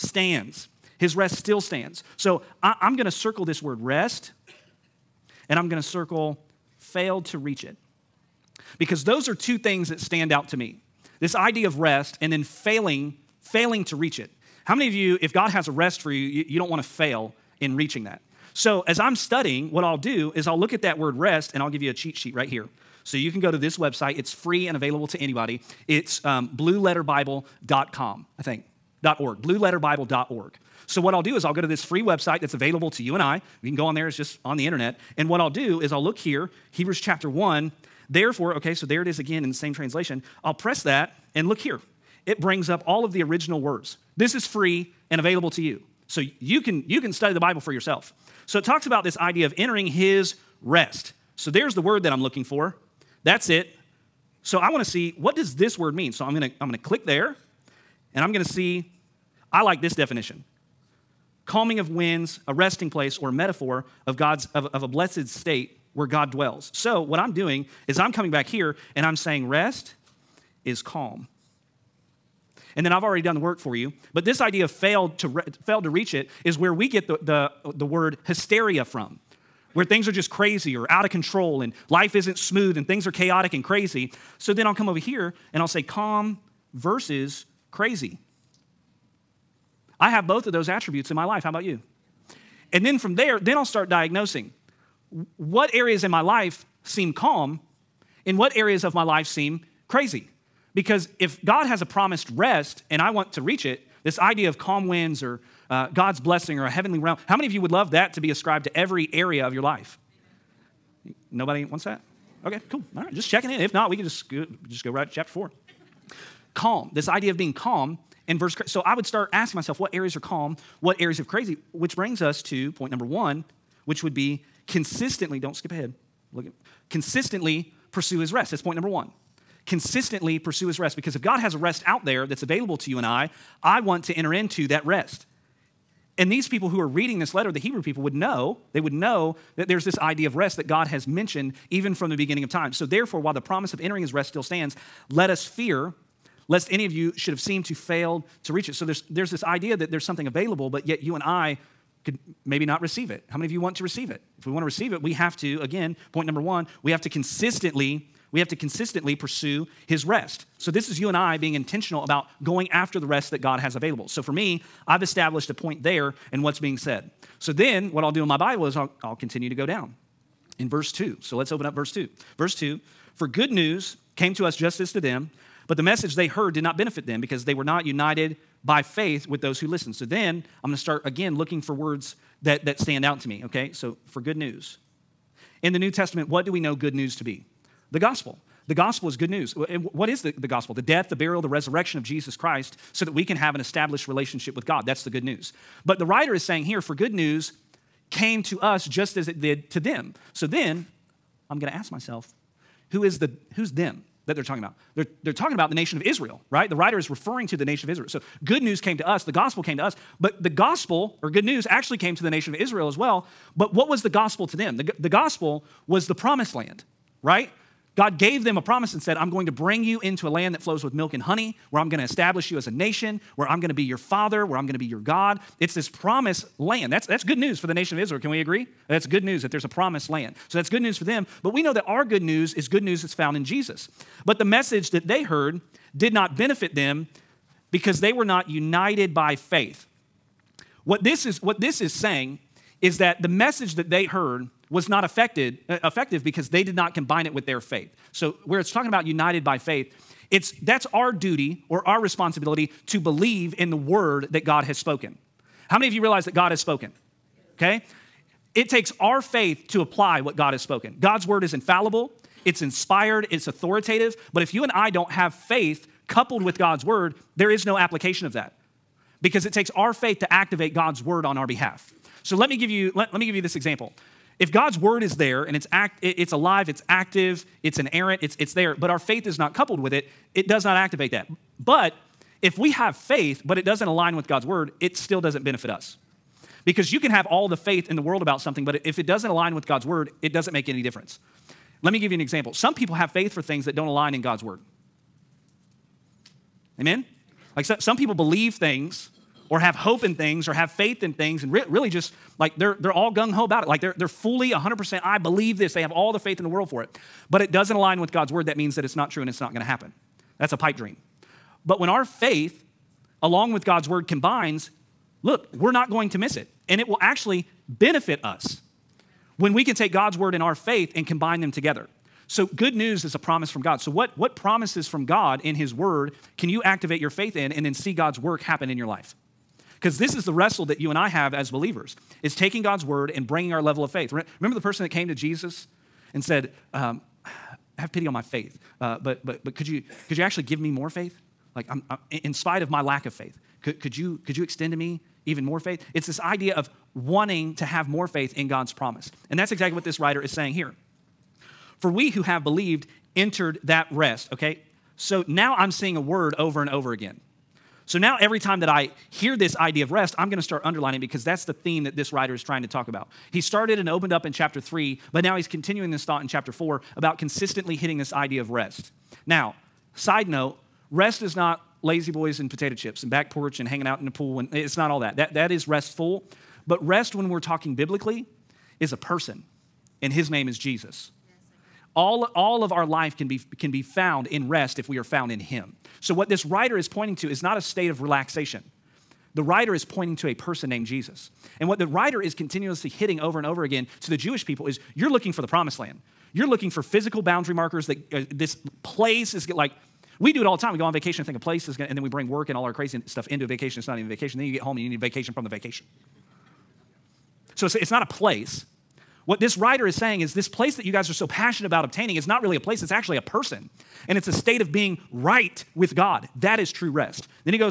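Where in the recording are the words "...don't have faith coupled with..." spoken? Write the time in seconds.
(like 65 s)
264 s.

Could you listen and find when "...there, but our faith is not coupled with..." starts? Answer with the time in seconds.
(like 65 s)
278 s.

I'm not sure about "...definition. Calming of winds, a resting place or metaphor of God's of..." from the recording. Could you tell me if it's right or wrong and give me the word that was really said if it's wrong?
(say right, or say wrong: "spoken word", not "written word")
right.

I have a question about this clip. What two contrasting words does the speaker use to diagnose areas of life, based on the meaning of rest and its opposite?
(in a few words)
calm versus crazy.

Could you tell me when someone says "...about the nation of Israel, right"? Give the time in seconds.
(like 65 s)
205 s.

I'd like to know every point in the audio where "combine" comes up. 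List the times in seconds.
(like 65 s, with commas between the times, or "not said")
246 s, 314 s, 321 s.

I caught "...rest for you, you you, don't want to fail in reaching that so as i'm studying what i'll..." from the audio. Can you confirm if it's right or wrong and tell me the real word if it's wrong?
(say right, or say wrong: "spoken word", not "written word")
right.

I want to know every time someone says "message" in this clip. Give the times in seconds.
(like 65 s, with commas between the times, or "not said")
175 s, 234 s, 243 s.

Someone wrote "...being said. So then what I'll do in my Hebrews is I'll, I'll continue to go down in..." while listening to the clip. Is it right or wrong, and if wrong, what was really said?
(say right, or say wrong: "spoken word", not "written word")
wrong: "Bible", not "Hebrews".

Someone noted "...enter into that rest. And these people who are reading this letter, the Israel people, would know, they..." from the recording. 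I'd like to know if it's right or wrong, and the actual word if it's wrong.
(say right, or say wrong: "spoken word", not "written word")
wrong: "Hebrew", not "Israel".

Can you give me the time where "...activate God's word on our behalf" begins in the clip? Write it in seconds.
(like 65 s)
270 s.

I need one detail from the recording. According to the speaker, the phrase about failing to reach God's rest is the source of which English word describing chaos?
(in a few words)
hysteria.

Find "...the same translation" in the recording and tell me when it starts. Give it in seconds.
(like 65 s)
39 s.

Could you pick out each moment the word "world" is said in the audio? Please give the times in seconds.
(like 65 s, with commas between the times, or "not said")
287 s, 306 s.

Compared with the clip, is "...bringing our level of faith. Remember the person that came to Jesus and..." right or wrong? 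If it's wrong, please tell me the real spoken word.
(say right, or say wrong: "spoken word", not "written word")
right.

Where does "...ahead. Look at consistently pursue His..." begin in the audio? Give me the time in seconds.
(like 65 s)
125 s.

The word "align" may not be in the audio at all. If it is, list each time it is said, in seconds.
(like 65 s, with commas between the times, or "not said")
283 s, 289 s, 293 s, 307 s.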